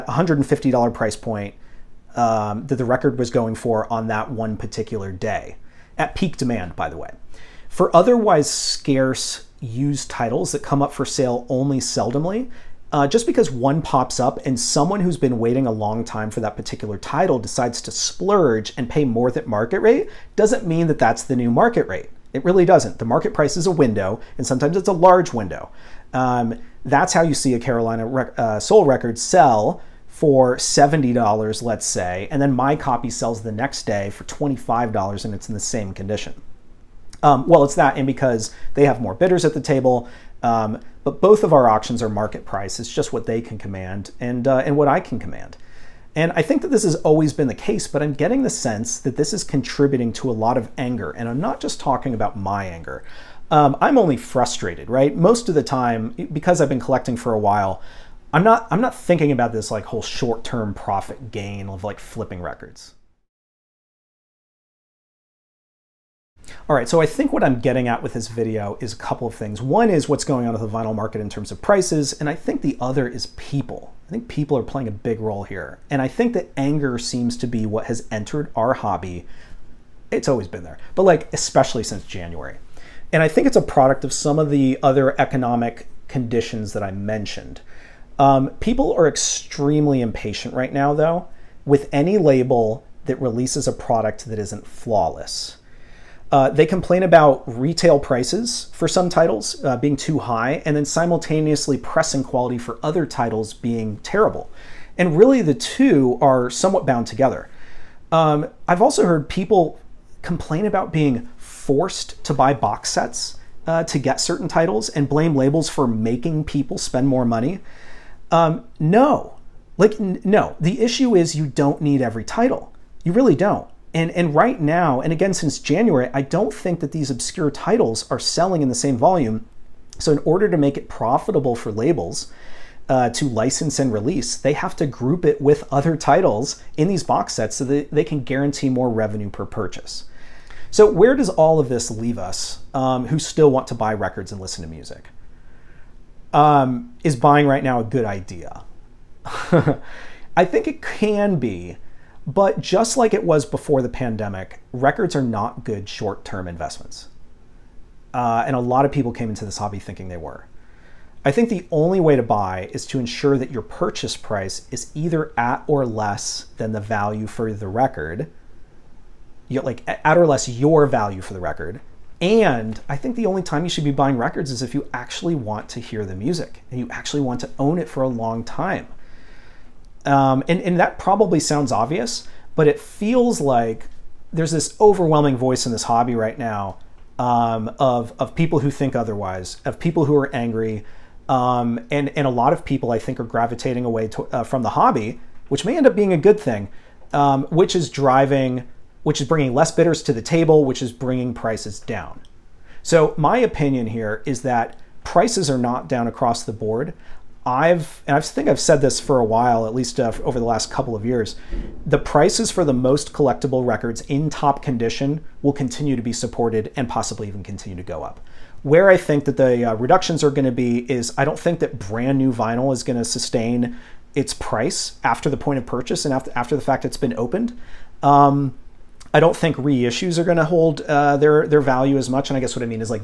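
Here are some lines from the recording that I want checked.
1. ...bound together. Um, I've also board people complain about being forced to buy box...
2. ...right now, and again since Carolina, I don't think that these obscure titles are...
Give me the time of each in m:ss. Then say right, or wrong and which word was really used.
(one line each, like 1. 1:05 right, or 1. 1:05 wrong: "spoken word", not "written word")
1. 1:46 wrong: "heard", not "board"
2. 2:04 wrong: "January", not "Carolina".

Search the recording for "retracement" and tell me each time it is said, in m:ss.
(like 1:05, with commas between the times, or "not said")
not said.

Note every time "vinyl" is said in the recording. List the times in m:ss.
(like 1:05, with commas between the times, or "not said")
1:10, 3:42.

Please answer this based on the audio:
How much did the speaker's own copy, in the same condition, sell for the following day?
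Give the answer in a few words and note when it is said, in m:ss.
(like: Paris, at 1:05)
$25, at 0:34.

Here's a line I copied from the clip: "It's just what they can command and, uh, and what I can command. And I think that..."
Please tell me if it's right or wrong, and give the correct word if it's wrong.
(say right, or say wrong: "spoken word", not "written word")
right.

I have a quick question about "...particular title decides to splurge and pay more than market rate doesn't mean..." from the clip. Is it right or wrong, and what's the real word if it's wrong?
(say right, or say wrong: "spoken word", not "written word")
right.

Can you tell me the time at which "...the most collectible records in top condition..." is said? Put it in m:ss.
3:32.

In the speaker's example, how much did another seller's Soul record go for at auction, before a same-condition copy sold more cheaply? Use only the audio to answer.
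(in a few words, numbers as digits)
$70.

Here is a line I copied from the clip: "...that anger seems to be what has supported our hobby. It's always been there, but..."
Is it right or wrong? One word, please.
wrong.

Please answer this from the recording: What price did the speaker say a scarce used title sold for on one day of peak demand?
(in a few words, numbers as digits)
$150.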